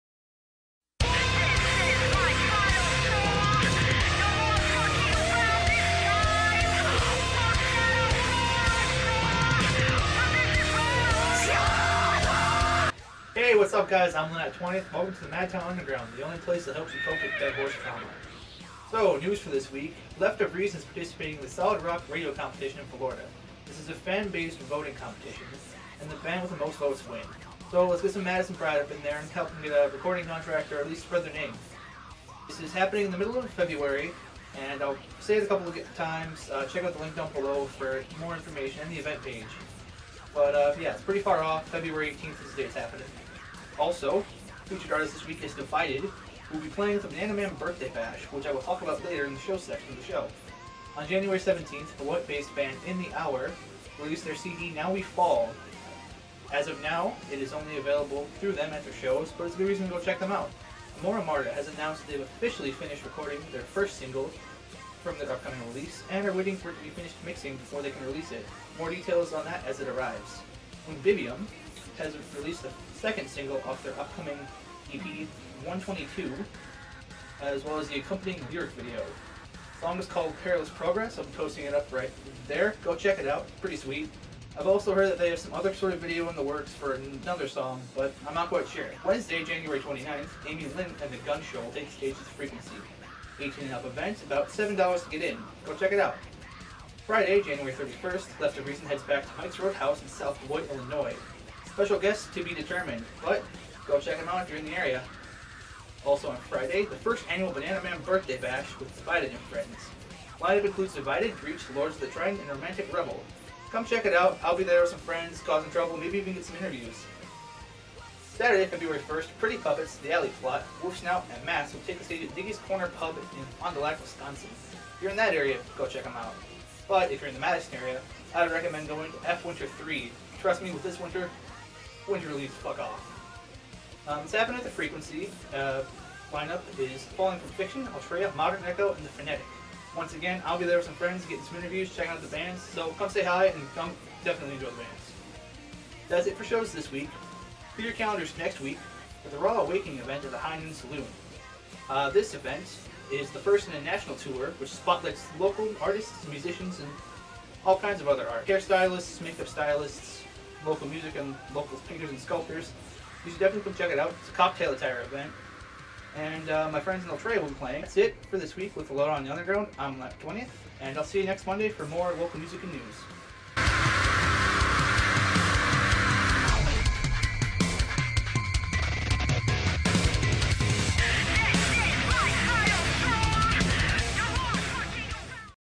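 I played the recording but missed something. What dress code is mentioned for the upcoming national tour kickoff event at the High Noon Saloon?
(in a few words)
Cocktail attire.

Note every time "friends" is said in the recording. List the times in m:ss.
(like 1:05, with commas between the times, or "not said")
1:49, 1:54, 2:20, 2:46.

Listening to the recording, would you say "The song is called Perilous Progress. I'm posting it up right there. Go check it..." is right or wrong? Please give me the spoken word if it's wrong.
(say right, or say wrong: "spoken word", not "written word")
right.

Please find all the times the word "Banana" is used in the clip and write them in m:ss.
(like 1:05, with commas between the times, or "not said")
0:47, 1:47.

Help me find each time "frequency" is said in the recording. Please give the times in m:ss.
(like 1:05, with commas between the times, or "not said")
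1:32, 2:14.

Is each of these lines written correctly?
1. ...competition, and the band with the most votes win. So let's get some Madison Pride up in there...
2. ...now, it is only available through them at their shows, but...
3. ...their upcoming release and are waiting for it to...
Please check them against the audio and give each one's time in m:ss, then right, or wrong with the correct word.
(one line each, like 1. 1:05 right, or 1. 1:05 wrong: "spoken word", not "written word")
1. 0:24 right
2. 0:56 right
3. 1:05 right.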